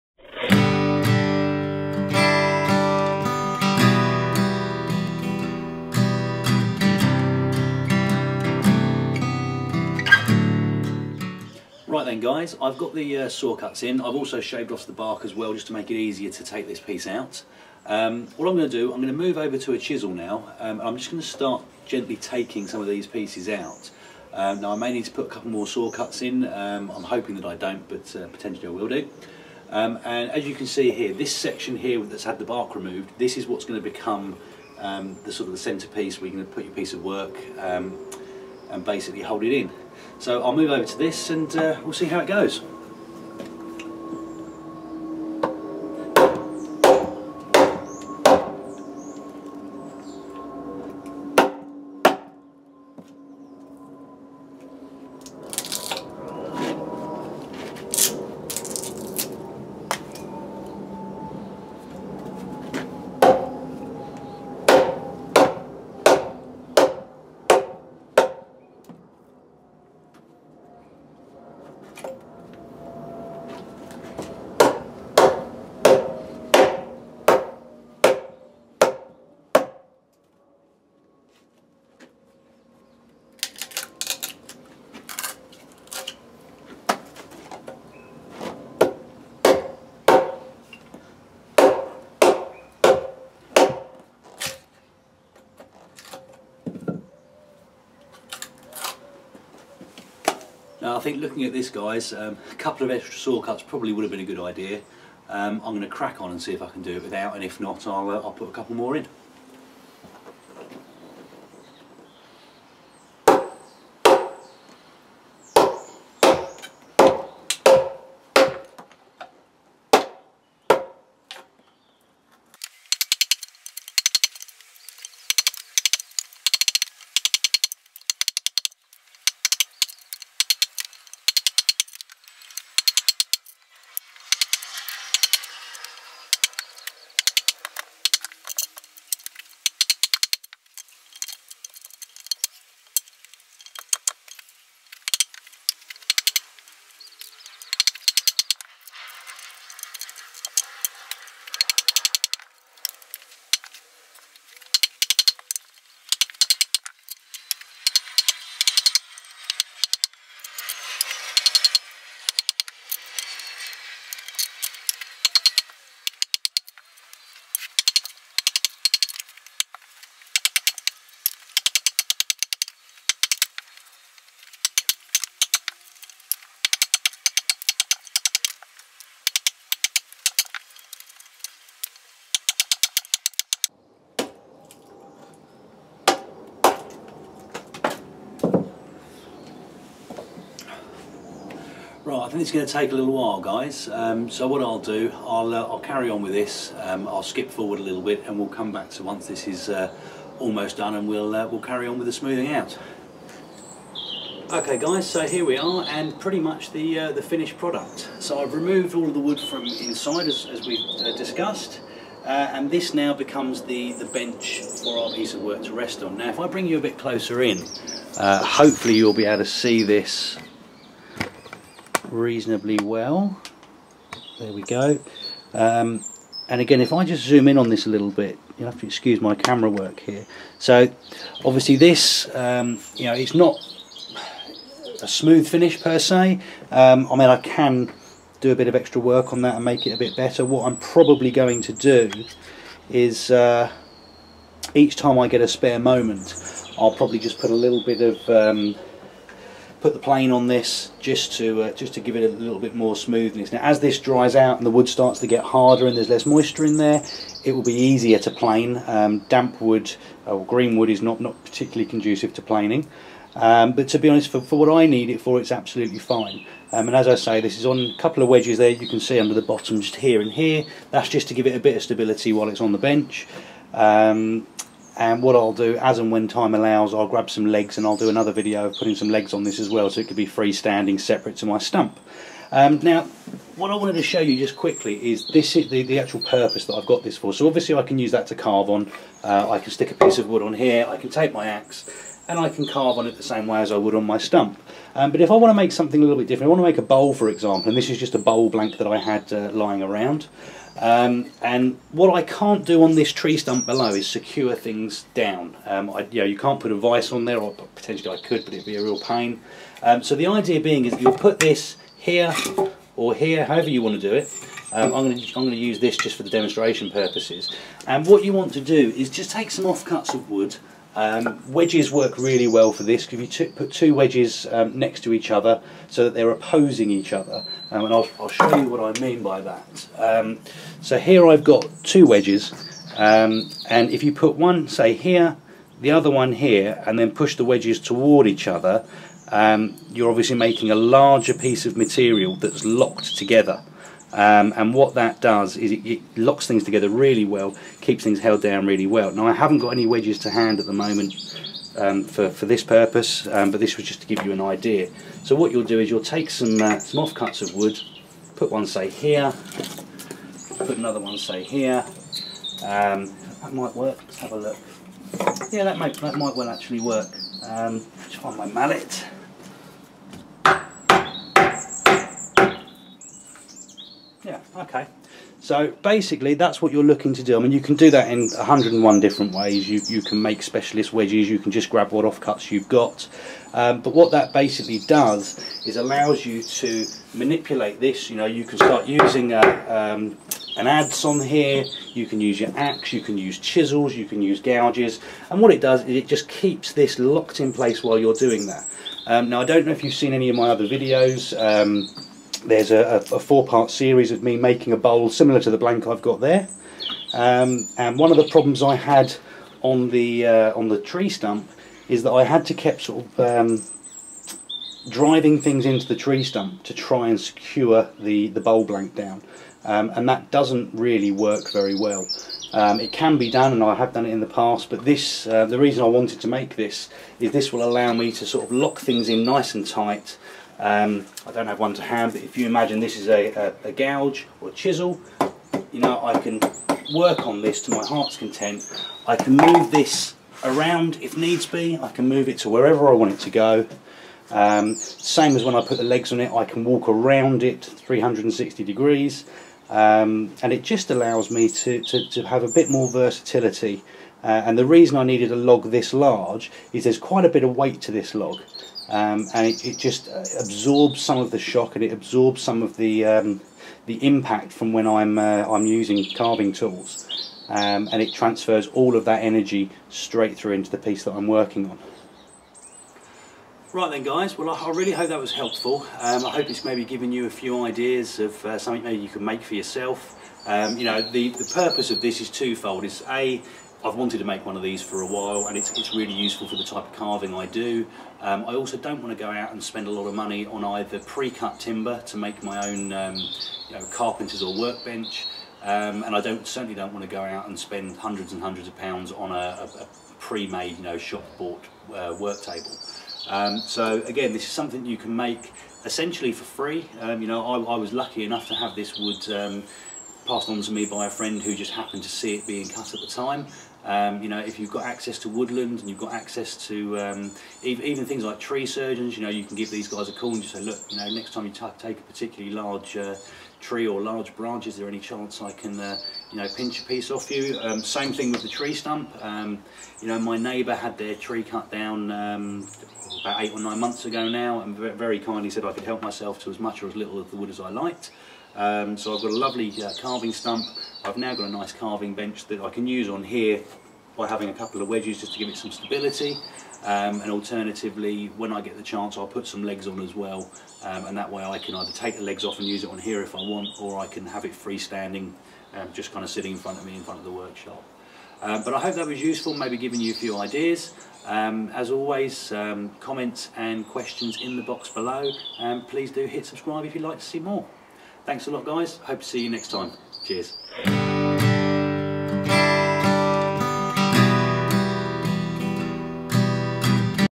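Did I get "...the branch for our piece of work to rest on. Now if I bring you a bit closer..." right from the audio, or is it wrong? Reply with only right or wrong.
wrong.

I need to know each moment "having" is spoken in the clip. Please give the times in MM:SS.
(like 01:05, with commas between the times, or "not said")
09:04.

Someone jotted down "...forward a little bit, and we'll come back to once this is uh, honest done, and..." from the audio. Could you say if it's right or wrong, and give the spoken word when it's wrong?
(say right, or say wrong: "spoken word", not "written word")
wrong: "almost", not "honest".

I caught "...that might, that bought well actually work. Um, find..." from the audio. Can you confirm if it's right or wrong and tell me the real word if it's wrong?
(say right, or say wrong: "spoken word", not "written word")
wrong: "might", not "bought".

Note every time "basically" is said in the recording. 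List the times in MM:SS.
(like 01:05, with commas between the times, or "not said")
00:38, 06:15, 06:24.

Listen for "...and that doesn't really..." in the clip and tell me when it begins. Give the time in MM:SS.
06:59.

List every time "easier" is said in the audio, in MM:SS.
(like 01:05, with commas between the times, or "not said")
00:15, 04:17.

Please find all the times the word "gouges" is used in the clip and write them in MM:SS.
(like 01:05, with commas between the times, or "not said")
06:34, 07:13.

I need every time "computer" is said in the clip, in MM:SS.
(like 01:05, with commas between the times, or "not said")
not said.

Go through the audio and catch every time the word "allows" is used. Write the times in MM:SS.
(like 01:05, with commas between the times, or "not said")
04:36, 06:25, 07:07, 07:30.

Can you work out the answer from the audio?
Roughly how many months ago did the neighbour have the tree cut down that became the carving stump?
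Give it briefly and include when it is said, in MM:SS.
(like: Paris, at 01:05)
8 or 9 months, at 08:53.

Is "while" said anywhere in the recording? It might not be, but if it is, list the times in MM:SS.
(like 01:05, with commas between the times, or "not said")
03:13, 04:32, 06:37, 08:05.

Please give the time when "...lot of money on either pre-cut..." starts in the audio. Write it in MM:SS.
08:09.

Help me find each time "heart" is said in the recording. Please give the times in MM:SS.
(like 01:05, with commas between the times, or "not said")
07:17.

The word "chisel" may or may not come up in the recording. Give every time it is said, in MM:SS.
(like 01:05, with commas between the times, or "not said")
00:19, 06:33, 07:14.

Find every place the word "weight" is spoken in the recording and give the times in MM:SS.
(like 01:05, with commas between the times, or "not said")
07:37.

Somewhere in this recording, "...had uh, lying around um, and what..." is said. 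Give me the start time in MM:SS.
04:58.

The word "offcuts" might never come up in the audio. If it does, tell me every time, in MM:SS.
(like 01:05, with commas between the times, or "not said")
05:19, 05:57, 06:22.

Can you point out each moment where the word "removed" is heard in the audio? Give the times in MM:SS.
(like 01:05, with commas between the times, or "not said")
00:32, 03:28.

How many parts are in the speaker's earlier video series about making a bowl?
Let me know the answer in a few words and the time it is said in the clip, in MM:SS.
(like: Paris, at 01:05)
4, at 06:43.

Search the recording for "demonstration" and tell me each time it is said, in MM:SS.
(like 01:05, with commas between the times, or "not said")
05:16.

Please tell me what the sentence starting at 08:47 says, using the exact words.
Um, same thing with the tree stump.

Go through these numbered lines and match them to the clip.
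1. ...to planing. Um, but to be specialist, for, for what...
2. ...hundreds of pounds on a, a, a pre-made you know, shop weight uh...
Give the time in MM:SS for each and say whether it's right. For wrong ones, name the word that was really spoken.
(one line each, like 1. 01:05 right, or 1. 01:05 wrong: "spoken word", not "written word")
1. 04:22 wrong: "honest", not "specialist"
2. 08:18 wrong: "bought", not "weight".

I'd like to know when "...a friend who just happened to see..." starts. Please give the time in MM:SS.
08:31.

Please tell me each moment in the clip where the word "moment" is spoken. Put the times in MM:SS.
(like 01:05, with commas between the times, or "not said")
04:05, 05:50.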